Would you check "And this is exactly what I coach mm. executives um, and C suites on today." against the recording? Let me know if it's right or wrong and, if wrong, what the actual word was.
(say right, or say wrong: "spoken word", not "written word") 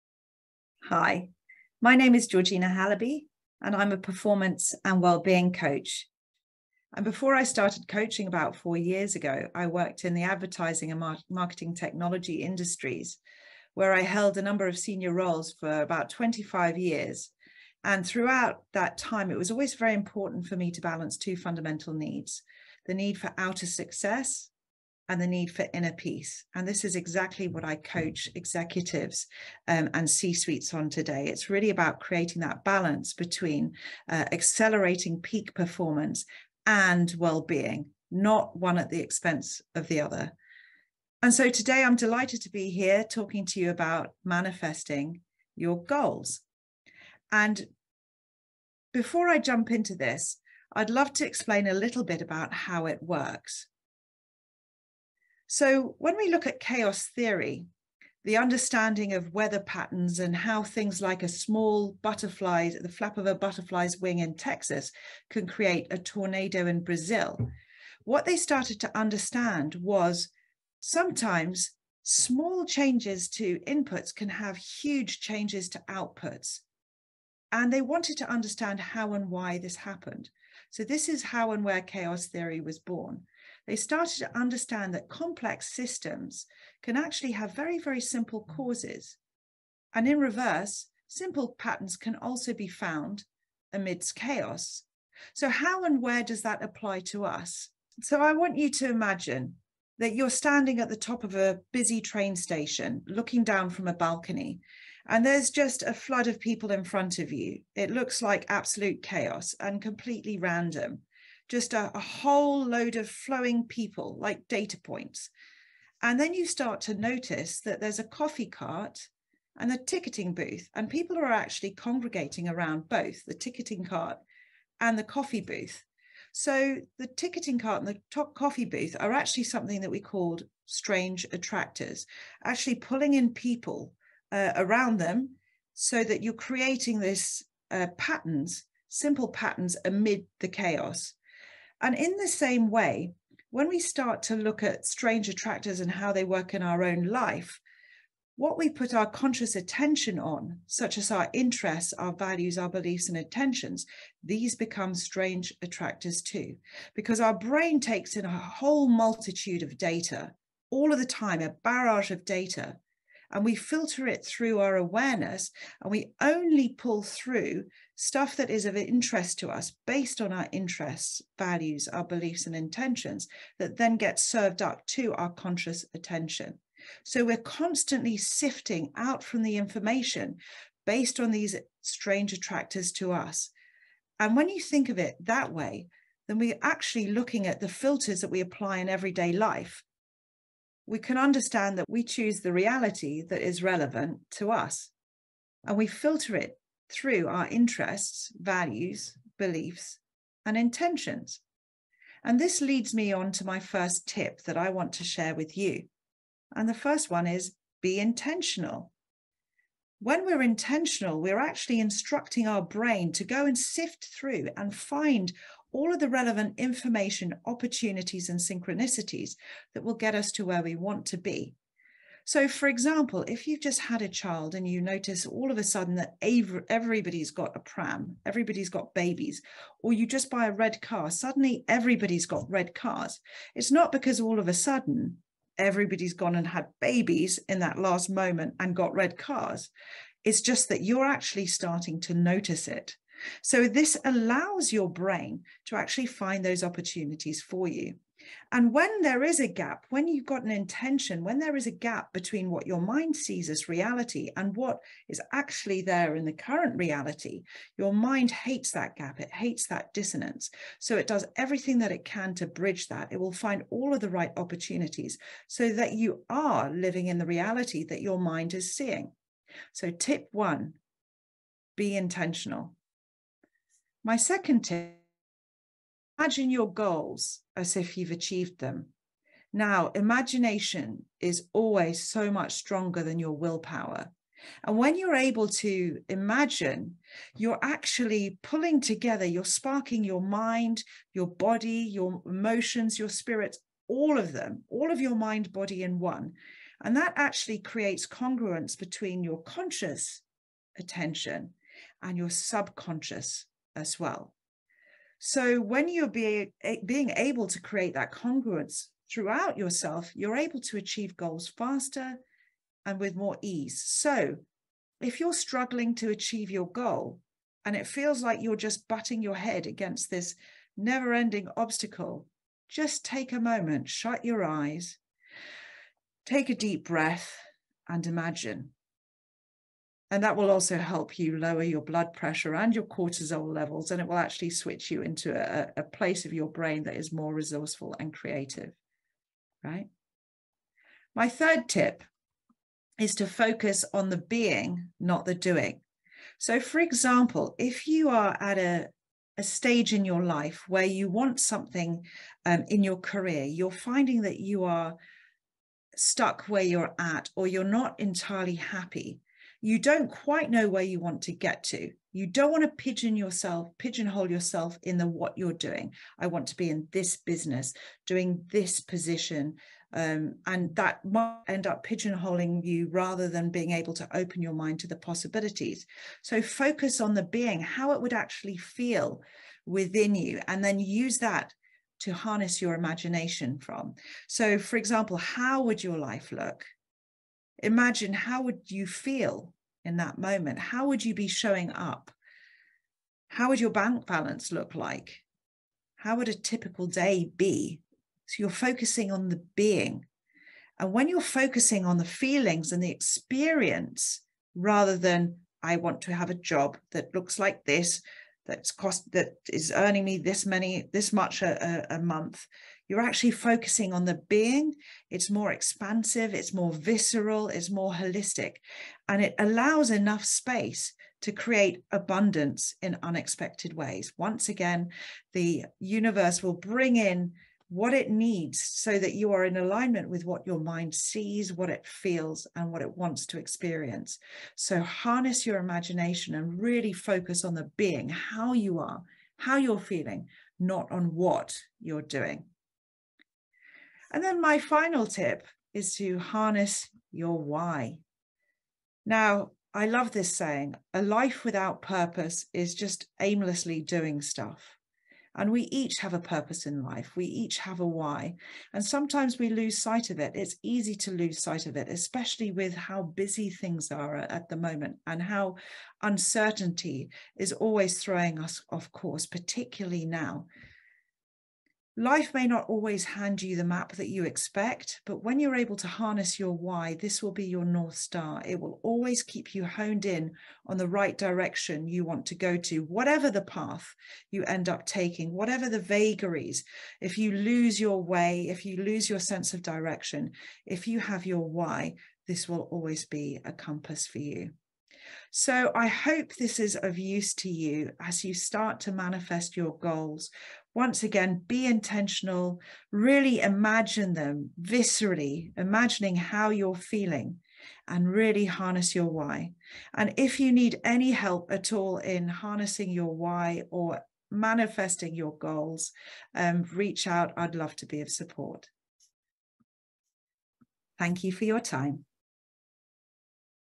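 right.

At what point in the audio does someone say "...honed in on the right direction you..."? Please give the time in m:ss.
7:59.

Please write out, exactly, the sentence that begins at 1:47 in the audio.
It looks like absolute chaos and completely random just a, a whole load of flowing people like data points.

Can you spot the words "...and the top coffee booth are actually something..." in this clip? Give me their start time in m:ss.
2:07.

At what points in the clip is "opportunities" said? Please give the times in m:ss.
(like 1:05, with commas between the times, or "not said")
3:37, 4:06, 4:24.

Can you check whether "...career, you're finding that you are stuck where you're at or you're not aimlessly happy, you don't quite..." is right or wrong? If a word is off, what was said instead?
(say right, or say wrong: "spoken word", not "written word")
wrong: "entirely", not "aimlessly".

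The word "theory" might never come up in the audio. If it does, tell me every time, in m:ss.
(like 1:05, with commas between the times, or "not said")
0:57, 1:22.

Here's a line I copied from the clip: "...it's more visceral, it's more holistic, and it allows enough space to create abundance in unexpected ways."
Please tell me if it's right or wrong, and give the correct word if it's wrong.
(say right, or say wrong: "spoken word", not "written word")
right.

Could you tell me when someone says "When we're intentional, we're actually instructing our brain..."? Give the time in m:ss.
3:29.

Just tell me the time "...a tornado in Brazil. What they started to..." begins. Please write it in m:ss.
1:05.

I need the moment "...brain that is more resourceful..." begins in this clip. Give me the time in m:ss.
5:36.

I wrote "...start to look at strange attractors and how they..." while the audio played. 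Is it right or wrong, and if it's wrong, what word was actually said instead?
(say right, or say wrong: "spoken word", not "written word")
right.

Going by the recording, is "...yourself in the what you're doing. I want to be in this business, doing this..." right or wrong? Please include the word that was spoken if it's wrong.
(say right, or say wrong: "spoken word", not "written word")
right.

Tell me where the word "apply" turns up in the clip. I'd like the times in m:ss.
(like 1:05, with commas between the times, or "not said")
1:36, 3:08.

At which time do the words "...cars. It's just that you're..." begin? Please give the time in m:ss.
3:59.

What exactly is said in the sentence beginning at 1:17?
And they wanted to understand how and why this happened.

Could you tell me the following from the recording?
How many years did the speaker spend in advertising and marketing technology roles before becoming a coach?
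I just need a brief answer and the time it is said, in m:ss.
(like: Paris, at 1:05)
25, at 0:16.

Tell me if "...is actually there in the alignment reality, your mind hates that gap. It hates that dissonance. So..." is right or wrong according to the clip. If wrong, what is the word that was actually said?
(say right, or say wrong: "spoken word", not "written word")
wrong: "current", not "alignment".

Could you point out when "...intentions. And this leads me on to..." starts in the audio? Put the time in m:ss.
3:20.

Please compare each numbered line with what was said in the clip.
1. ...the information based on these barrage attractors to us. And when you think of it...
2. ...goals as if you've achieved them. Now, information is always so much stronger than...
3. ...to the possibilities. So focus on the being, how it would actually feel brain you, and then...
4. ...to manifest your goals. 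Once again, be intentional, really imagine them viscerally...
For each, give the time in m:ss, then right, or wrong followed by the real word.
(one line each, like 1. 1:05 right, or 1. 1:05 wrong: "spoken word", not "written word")
1. 2:59 wrong: "strange", not "barrage"
2. 4:36 wrong: "imagination", not "information"
3. 6:14 wrong: "within", not "brain"
4. 8:18 right.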